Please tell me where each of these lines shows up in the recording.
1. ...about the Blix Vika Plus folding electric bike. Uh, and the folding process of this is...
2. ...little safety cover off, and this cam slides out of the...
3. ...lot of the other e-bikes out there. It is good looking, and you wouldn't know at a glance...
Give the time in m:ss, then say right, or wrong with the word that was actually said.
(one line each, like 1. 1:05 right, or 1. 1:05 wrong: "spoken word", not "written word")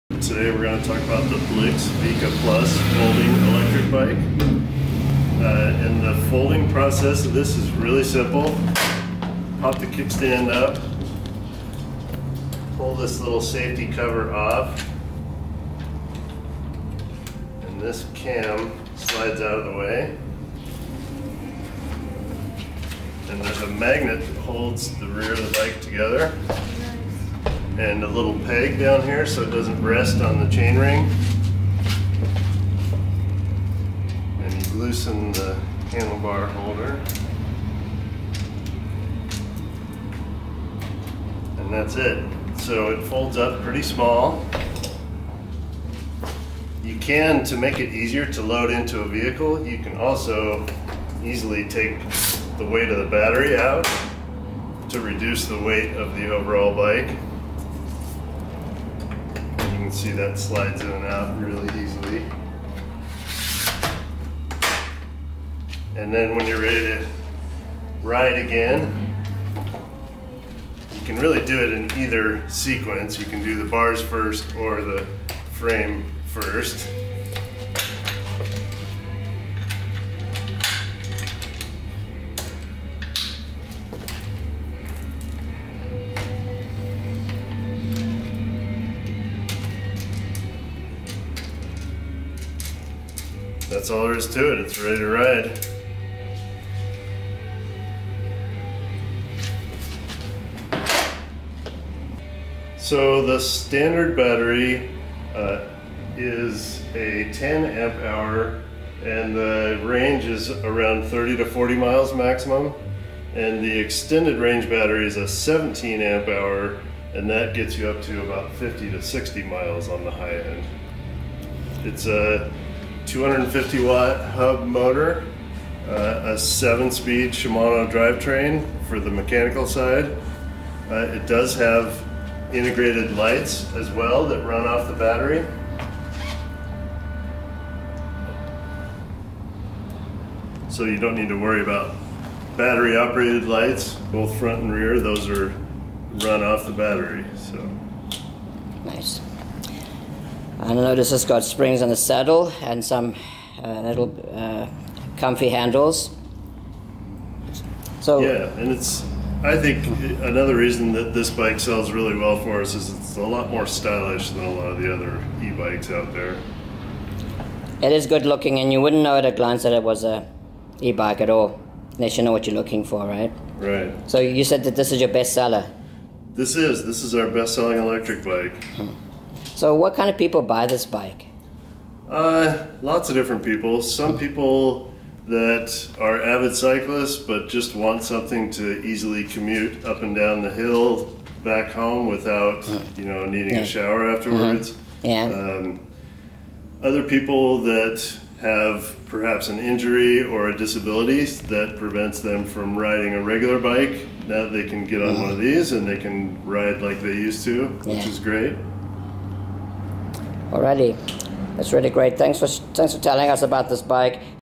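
1. 0:01 right
2. 0:13 right
3. 2:44 right.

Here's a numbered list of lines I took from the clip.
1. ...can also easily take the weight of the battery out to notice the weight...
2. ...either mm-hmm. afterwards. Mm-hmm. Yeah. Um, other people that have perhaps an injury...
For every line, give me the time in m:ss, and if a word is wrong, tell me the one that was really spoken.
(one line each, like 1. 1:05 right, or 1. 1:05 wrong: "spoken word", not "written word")
1. 0:49 wrong: "reduce", not "notice"
2. 3:13 wrong: "shower", not "either".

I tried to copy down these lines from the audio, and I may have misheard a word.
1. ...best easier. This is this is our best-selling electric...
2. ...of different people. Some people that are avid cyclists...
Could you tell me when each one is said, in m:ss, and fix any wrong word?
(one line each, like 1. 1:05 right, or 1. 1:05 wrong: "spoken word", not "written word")
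1. 2:55 wrong: "seller", not "easier"
2. 3:03 right.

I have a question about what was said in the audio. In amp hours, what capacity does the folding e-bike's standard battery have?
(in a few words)
10 amp hour.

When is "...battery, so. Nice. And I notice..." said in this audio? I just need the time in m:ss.
2:26.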